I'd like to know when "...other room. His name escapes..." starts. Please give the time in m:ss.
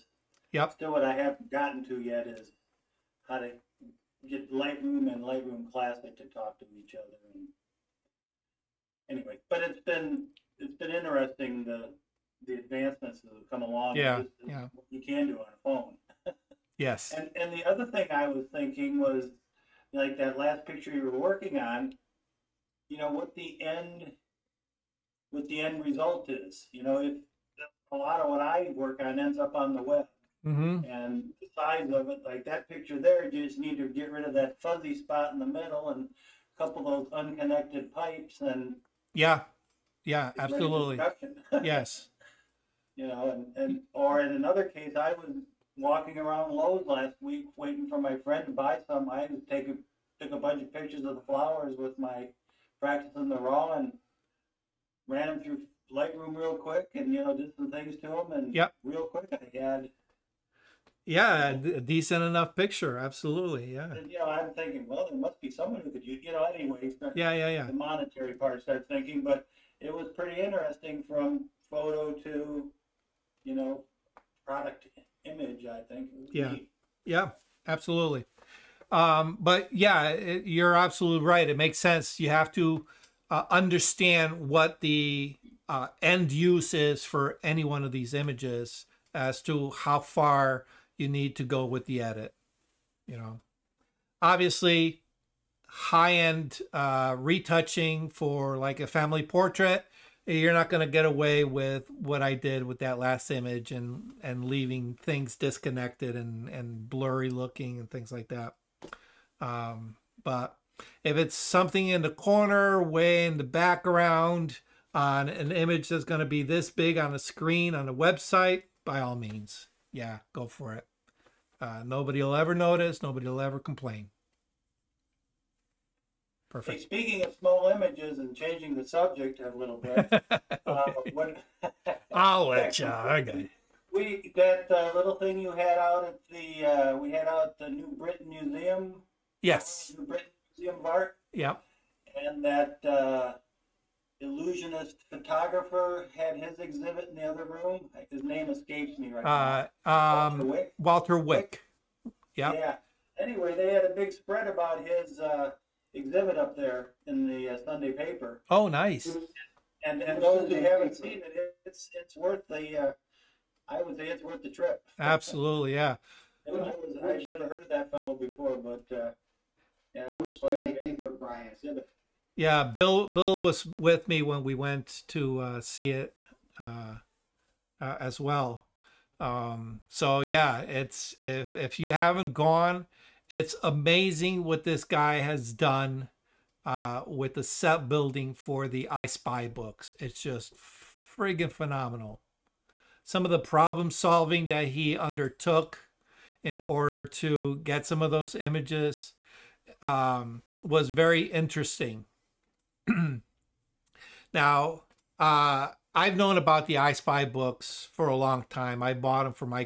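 2:27.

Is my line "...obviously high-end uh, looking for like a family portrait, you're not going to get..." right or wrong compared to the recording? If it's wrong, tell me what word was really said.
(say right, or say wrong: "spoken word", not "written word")
wrong: "retouching", not "looking".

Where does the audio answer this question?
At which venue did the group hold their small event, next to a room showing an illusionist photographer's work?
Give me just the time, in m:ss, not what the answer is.
2:19.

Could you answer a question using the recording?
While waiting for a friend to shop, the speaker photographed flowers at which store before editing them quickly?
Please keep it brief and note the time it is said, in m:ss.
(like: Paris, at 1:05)
Lowe's, at 0:46.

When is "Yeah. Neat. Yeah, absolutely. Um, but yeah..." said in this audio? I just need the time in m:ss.
1:16.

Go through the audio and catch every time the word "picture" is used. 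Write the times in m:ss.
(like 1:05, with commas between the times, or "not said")
0:20, 0:32, 0:50, 1:02.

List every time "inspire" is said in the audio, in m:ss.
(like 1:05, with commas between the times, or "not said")
not said.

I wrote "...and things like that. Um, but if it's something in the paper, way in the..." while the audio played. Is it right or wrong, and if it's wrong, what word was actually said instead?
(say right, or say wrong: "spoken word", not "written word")
wrong: "corner", not "paper".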